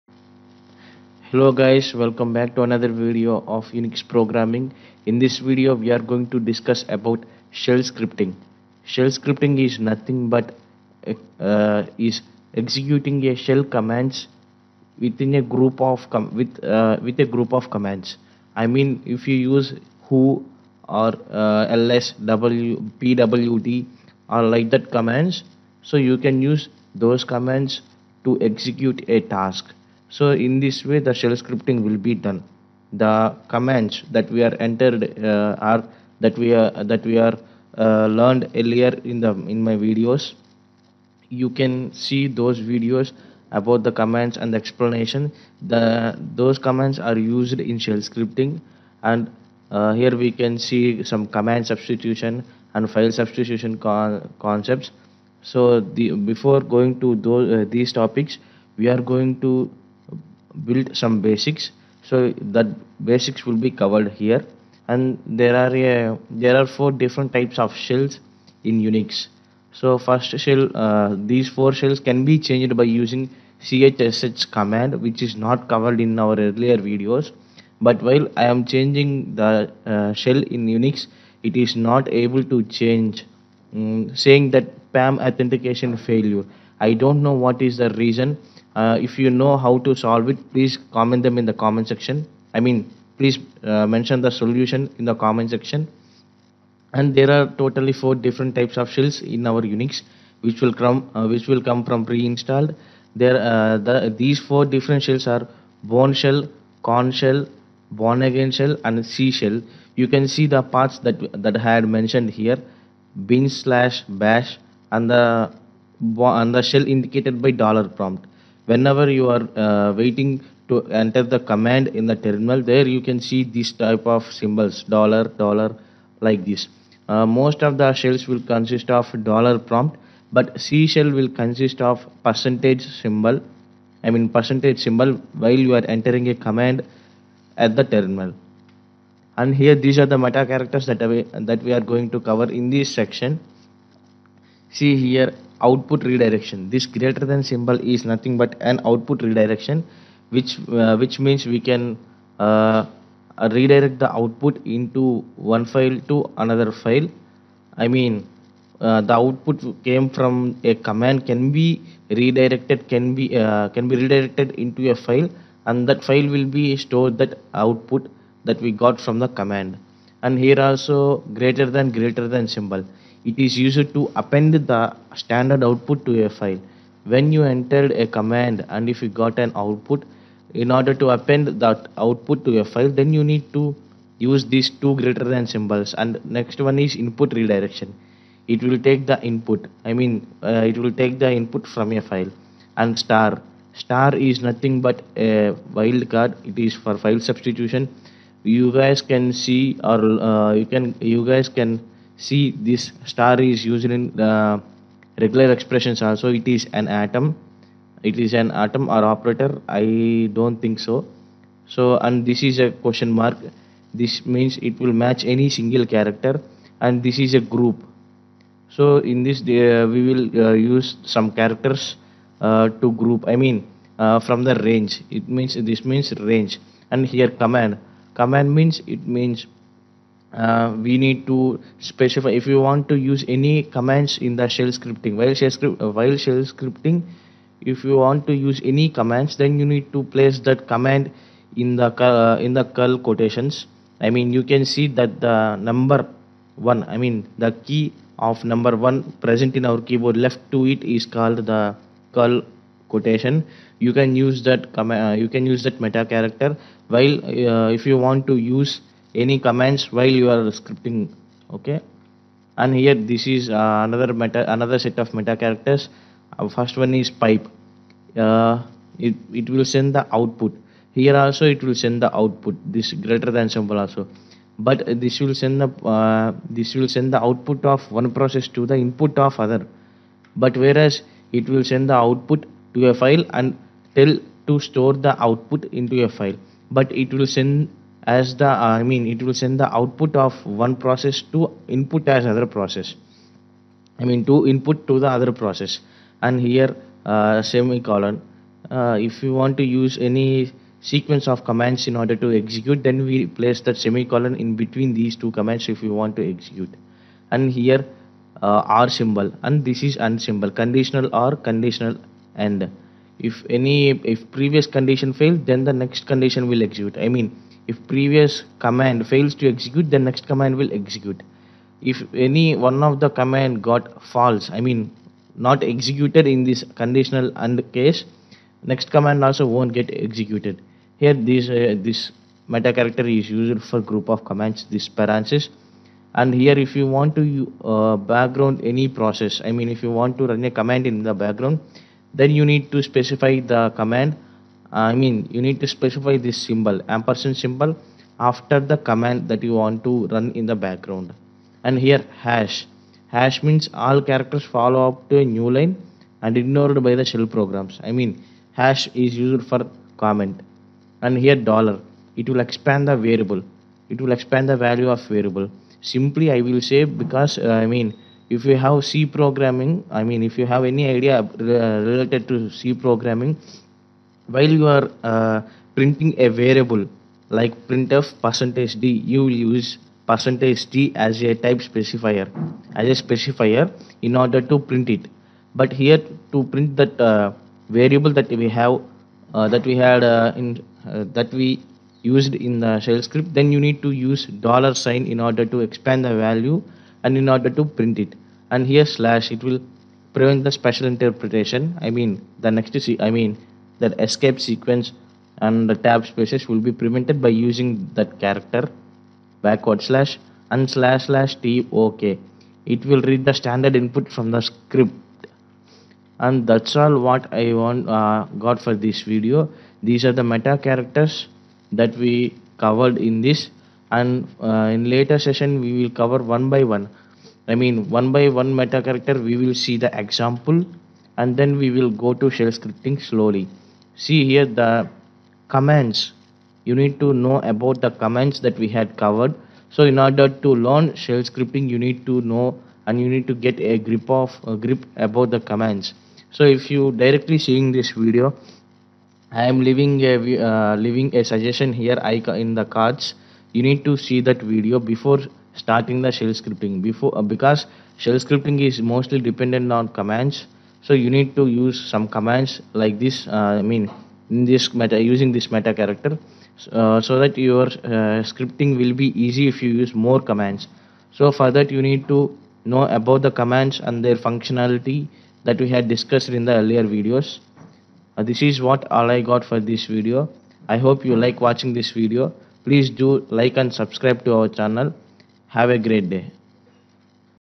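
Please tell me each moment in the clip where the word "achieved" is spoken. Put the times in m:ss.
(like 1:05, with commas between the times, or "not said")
not said.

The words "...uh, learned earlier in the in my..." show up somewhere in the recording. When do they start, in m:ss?
0:37.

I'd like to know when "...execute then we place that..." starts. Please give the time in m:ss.
5:02.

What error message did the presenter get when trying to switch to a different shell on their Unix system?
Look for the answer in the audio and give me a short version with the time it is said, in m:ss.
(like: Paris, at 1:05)
PAM authentication failure, at 1:24.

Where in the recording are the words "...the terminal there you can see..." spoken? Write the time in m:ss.
2:02.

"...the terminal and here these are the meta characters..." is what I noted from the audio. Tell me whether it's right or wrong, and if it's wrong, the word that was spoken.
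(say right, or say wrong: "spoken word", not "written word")
right.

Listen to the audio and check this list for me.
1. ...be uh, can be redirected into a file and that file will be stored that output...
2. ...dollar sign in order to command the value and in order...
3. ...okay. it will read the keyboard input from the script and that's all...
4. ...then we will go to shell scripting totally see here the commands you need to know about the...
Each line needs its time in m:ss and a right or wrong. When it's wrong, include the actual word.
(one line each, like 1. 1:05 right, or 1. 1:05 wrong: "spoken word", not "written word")
1. 2:43 right
2. 6:34 wrong: "expand", not "command"
3. 6:51 wrong: "standard", not "keyboard"
4. 7:11 wrong: "slowly", not "totally".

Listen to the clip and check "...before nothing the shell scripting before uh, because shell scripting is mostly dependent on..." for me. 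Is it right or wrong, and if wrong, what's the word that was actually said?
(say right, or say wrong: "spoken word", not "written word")
wrong: "starting", not "nothing".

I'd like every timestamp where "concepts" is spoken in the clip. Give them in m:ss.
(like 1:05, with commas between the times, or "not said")
0:54.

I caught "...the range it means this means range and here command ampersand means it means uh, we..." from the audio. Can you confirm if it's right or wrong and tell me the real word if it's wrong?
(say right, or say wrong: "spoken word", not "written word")
wrong: "command", not "ampersand".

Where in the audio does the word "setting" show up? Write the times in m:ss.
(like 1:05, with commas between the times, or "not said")
not said.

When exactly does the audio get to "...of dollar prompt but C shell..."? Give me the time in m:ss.
2:08.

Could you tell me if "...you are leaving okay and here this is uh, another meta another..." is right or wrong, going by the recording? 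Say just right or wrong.
wrong.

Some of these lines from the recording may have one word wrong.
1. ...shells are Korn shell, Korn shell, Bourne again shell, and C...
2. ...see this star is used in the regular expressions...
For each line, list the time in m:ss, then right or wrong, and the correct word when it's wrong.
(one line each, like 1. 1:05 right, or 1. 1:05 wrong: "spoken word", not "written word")
1. 1:45 wrong: "Bourne", not "Korn"
2. 3:22 right.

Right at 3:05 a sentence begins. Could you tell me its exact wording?
And next one is input redirection.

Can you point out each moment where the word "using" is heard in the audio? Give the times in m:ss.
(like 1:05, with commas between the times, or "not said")
1:12, 6:47, 7:44.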